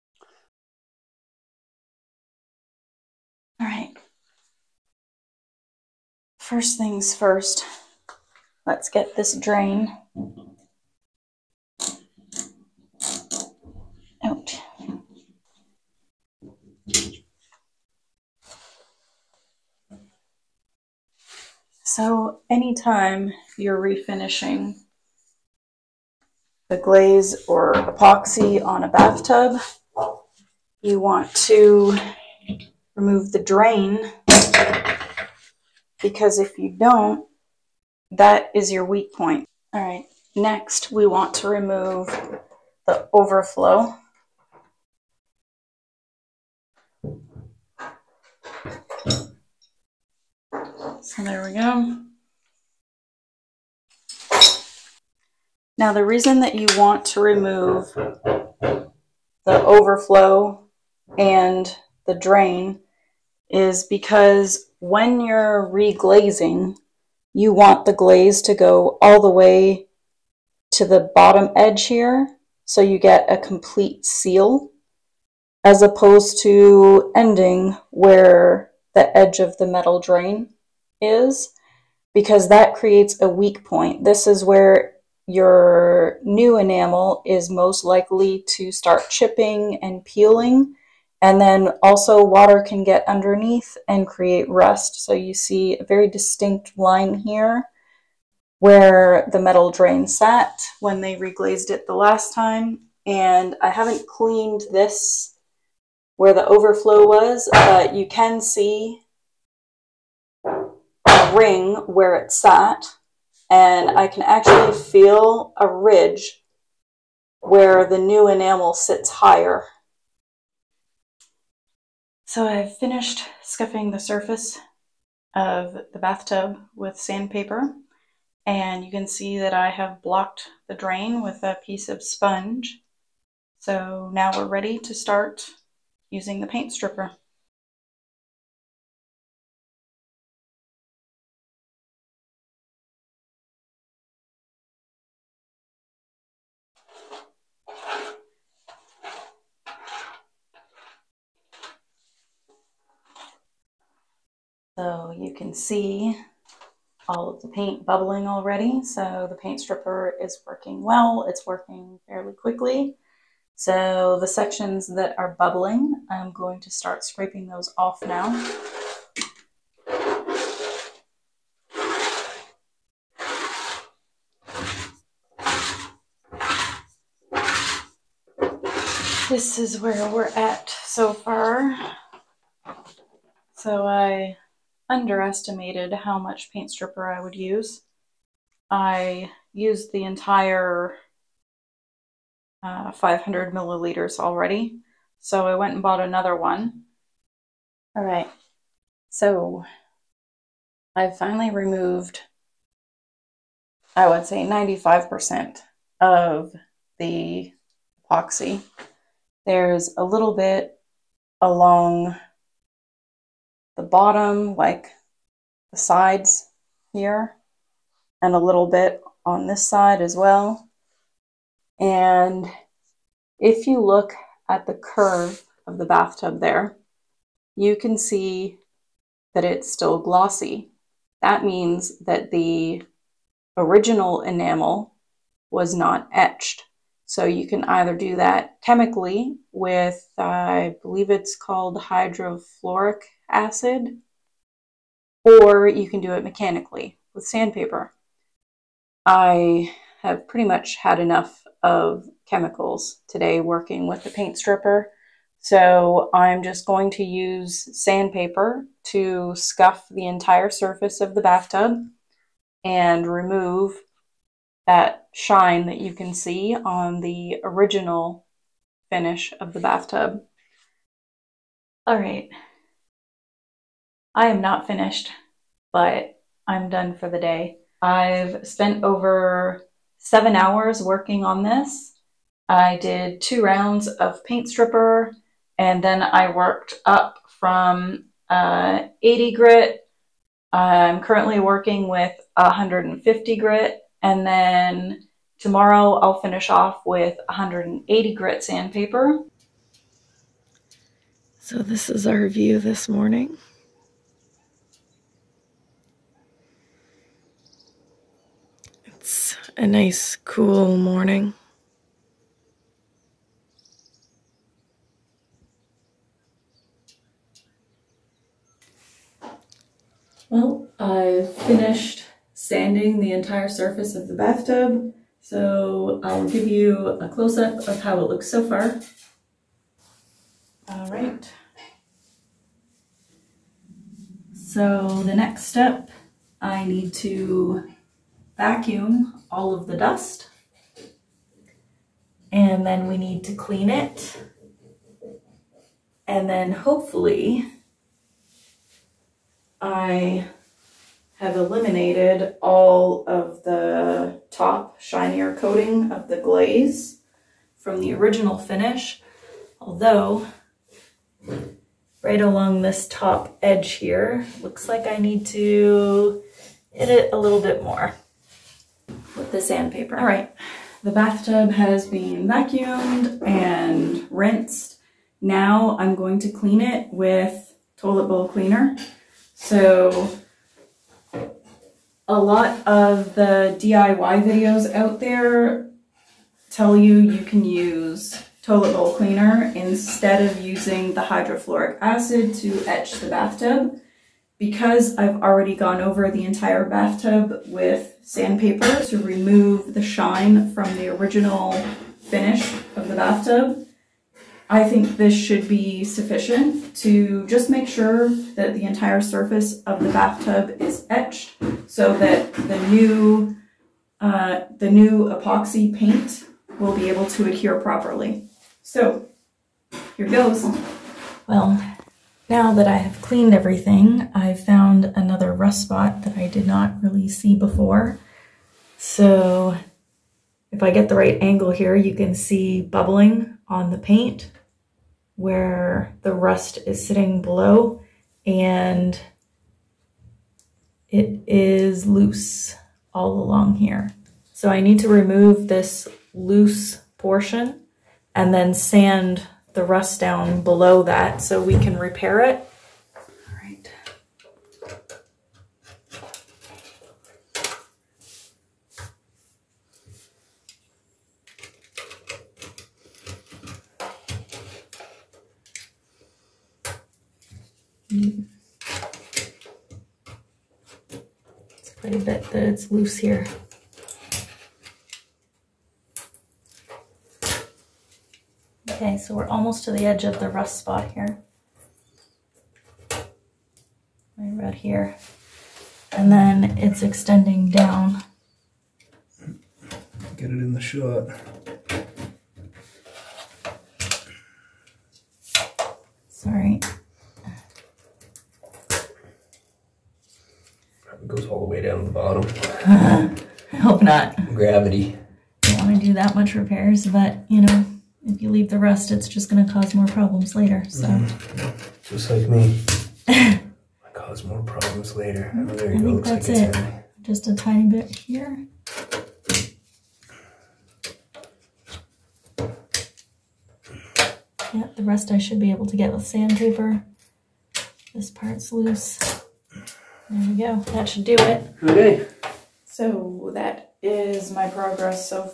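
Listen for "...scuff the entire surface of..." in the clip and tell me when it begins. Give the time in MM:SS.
04:19.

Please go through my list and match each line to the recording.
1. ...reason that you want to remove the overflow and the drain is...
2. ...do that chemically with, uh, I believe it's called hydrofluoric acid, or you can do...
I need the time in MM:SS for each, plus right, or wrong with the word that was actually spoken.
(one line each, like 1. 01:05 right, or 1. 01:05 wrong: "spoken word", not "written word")
1. 00:56 right
2. 03:57 right.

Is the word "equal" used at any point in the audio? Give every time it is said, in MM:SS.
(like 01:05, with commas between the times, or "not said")
not said.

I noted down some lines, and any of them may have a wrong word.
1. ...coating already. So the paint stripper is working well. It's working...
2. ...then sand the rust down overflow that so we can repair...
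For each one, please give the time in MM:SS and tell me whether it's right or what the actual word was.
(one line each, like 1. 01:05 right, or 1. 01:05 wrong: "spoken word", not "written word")
1. 02:37 wrong: "bubbling", not "coating"
2. 07:28 wrong: "below", not "overflow".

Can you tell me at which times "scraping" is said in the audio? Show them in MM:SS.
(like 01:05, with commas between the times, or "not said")
02:47.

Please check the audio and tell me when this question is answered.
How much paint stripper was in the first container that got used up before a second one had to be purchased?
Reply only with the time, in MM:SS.
03:12.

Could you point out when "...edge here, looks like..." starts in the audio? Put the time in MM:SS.
06:03.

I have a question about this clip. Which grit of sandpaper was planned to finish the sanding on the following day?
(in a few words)
180 grit.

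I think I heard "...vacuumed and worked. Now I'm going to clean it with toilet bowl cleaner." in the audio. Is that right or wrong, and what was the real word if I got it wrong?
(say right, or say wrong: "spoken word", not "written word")
wrong: "rinsed", not "worked".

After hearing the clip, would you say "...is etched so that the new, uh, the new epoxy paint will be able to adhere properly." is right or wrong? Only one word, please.
right.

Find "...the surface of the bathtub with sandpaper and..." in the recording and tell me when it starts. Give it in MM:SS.
02:03.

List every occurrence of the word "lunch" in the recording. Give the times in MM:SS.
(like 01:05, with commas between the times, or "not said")
not said.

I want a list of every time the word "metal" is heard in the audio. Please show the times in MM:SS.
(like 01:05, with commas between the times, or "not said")
01:19, 01:39.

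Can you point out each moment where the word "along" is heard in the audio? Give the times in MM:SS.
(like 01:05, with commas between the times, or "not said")
03:31, 06:02, 07:23.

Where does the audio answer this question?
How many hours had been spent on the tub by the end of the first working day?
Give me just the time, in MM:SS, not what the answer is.
04:39.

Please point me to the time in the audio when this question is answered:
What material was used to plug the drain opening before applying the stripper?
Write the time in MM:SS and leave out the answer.
02:12.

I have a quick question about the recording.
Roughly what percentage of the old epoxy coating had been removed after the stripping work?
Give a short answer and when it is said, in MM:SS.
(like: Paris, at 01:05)
95%, at 03:24.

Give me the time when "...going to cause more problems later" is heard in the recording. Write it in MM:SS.
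08:29.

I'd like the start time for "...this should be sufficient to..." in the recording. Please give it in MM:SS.
06:44.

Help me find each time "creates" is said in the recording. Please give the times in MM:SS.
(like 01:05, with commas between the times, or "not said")
01:22, 01:34.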